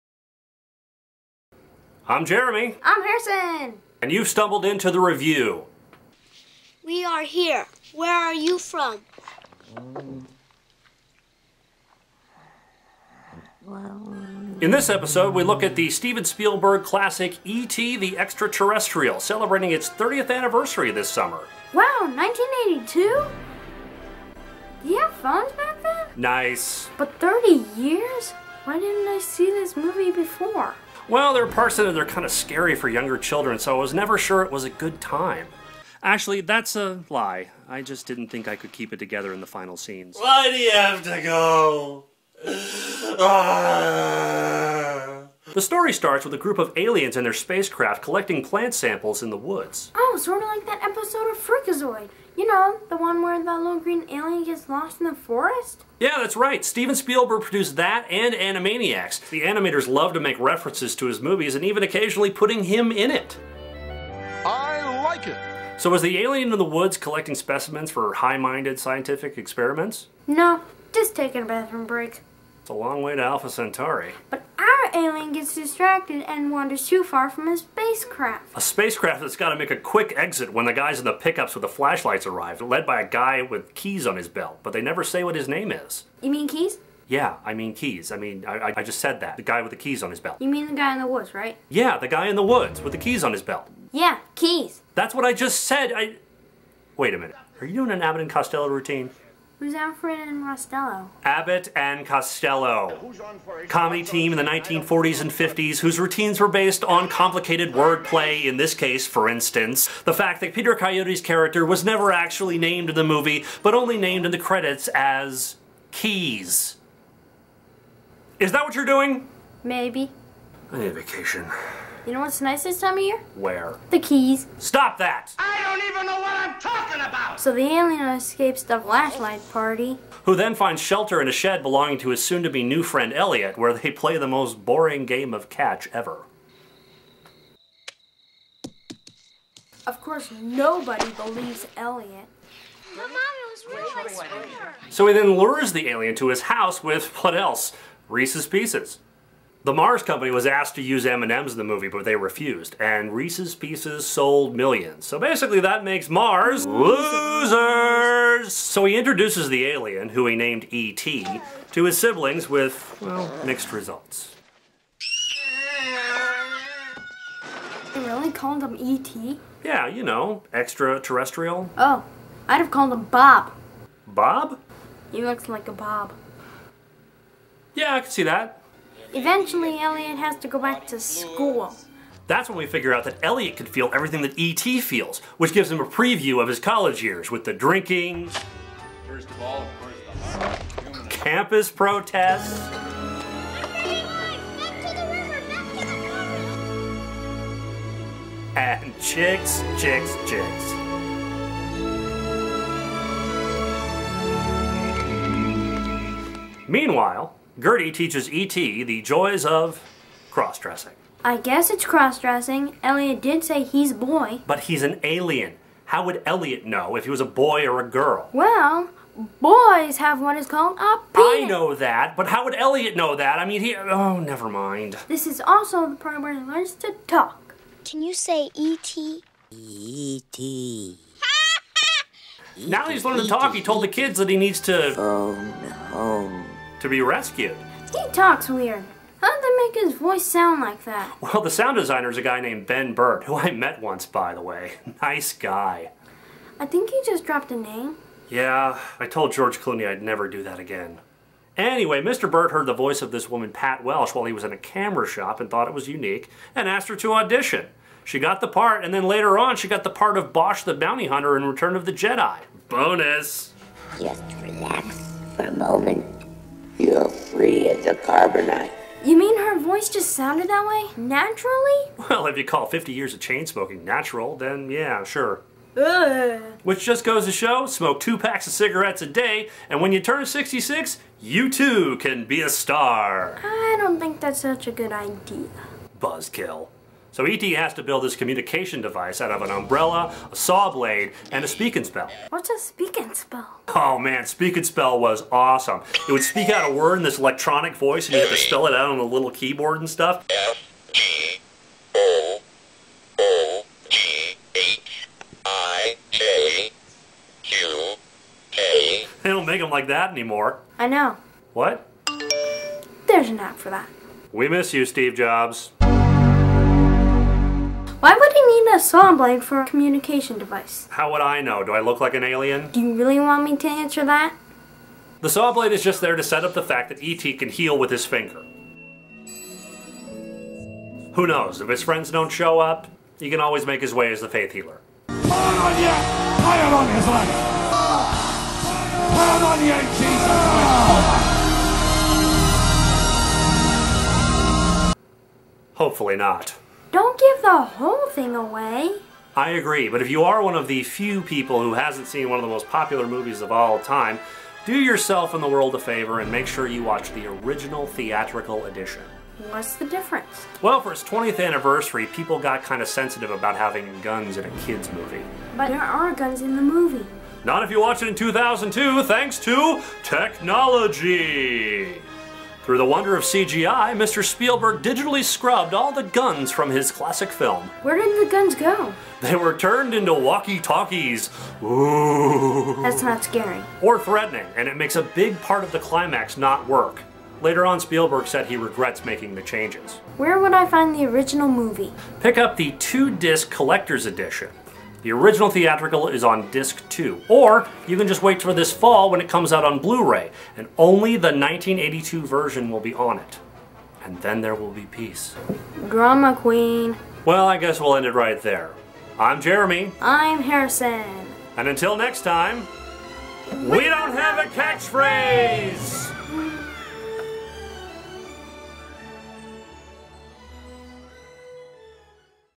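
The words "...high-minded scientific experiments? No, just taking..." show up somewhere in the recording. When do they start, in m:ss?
1:08.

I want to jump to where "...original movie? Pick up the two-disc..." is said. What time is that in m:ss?
6:31.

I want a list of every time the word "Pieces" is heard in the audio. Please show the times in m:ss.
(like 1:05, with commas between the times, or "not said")
2:28, 2:33.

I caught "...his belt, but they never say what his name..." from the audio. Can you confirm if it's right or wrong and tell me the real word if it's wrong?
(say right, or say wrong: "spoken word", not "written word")
right.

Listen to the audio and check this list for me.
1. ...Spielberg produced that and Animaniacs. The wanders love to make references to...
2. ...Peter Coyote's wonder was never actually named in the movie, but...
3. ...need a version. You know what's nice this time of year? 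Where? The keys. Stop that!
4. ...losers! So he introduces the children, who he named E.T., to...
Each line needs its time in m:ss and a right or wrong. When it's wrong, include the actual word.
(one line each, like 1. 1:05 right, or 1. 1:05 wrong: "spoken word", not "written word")
1. 0:56 wrong: "animators", not "wanders"
2. 1:50 wrong: "character", not "wonder"
3. 2:00 wrong: "vacation", not "version"
4. 2:36 wrong: "alien", not "children".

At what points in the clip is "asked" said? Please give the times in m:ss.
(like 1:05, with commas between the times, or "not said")
2:30, 4:16.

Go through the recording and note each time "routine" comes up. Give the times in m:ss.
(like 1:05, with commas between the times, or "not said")
1:38, 1:45.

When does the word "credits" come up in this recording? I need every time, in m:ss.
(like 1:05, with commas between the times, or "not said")
1:54.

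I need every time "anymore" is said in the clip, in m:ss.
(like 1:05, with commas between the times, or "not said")
5:10.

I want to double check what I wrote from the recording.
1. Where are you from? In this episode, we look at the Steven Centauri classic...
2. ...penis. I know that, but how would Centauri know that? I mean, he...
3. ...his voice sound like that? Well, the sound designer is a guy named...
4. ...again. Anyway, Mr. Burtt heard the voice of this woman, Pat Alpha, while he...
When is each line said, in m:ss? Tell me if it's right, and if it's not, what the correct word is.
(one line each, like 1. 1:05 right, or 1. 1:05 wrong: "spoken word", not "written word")
1. 0:07 wrong: "Spielberg", not "Centauri"
2. 3:41 wrong: "Elliot", not "Centauri"
3. 3:59 right
4. 4:10 wrong: "Welsh", not "Alpha".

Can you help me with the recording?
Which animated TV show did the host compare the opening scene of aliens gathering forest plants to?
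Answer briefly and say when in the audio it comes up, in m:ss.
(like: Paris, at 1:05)
Freakazoid, at 0:51.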